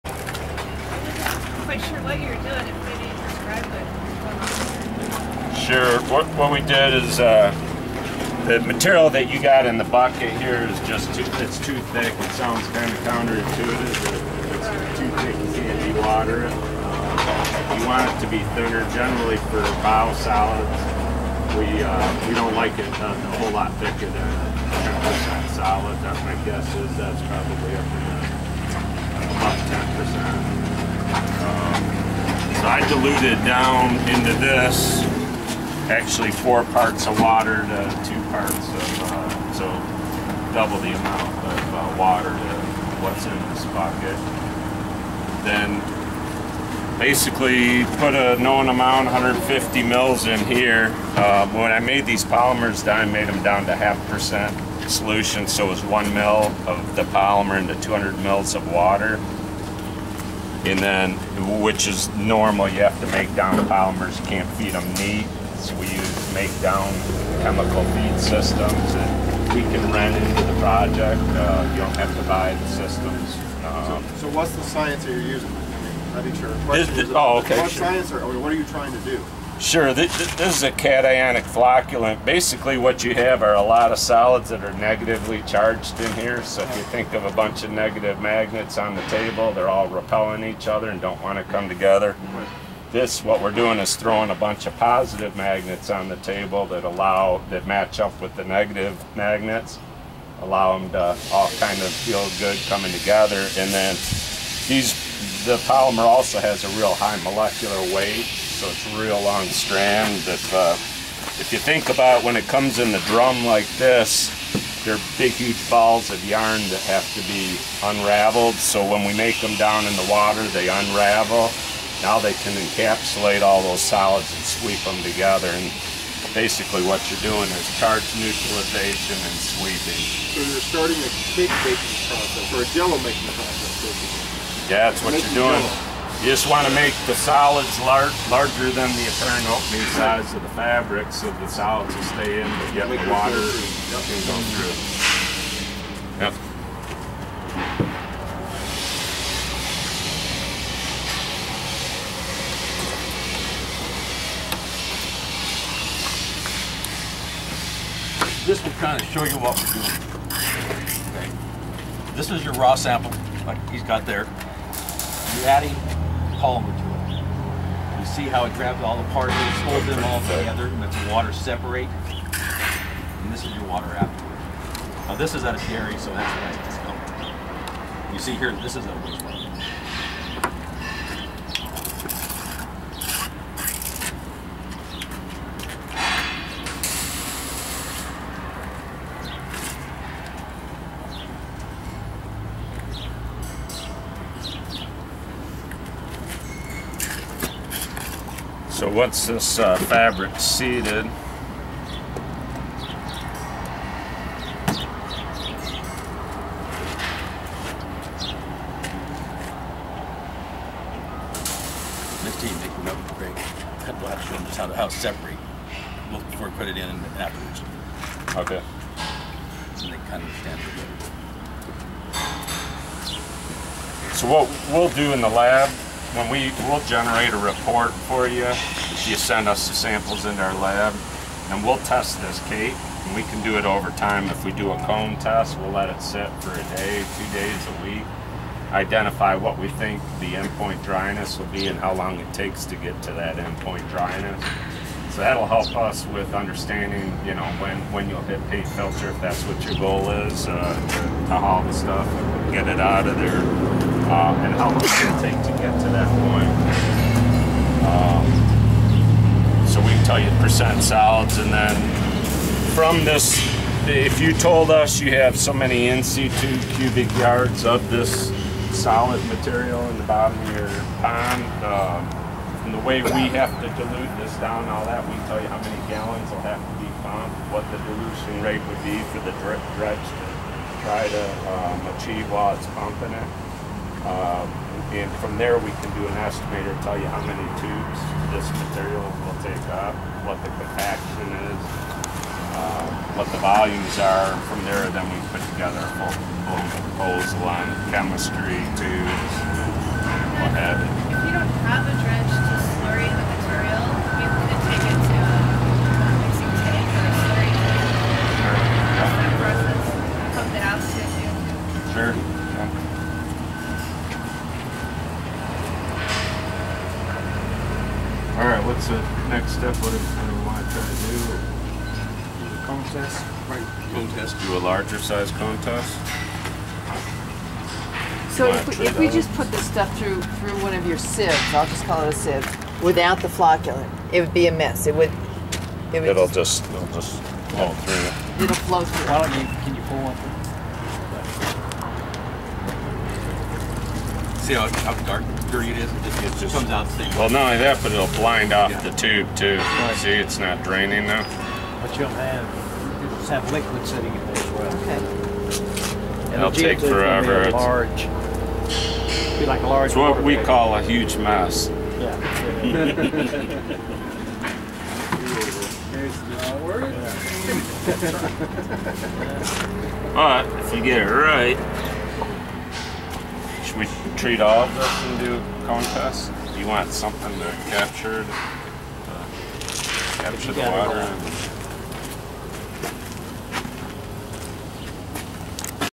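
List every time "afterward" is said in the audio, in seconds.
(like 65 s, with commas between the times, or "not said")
173 s, 217 s.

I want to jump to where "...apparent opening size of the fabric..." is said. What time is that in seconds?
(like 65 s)
139 s.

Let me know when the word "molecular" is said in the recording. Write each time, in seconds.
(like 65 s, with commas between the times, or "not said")
107 s.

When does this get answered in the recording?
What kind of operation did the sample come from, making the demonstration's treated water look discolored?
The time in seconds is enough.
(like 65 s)
175 s.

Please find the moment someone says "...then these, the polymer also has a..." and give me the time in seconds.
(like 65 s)
103 s.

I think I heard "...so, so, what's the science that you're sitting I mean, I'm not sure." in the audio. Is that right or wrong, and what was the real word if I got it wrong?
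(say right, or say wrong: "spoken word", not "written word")
wrong: "using", not "sitting".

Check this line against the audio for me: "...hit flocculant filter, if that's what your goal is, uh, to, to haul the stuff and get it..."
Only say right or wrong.
wrong.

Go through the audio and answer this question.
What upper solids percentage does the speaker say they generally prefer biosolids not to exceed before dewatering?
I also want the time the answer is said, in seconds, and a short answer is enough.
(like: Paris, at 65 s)
10%, at 25 s.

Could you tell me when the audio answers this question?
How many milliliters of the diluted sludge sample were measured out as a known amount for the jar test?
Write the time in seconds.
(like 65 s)
49 s.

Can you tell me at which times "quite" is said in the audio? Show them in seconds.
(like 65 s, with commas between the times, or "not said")
1 s.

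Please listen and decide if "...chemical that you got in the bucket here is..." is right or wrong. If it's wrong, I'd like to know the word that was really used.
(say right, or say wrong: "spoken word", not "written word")
wrong: "material", not "chemical".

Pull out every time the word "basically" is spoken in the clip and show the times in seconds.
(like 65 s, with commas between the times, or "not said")
46 s, 82 s, 126 s, 133 s.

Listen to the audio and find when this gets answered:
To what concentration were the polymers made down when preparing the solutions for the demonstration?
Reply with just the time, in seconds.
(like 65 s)
53 s.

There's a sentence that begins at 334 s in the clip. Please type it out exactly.
It would, it would It'll just, it'll just flow through.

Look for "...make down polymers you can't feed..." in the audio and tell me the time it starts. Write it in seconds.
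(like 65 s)
63 s.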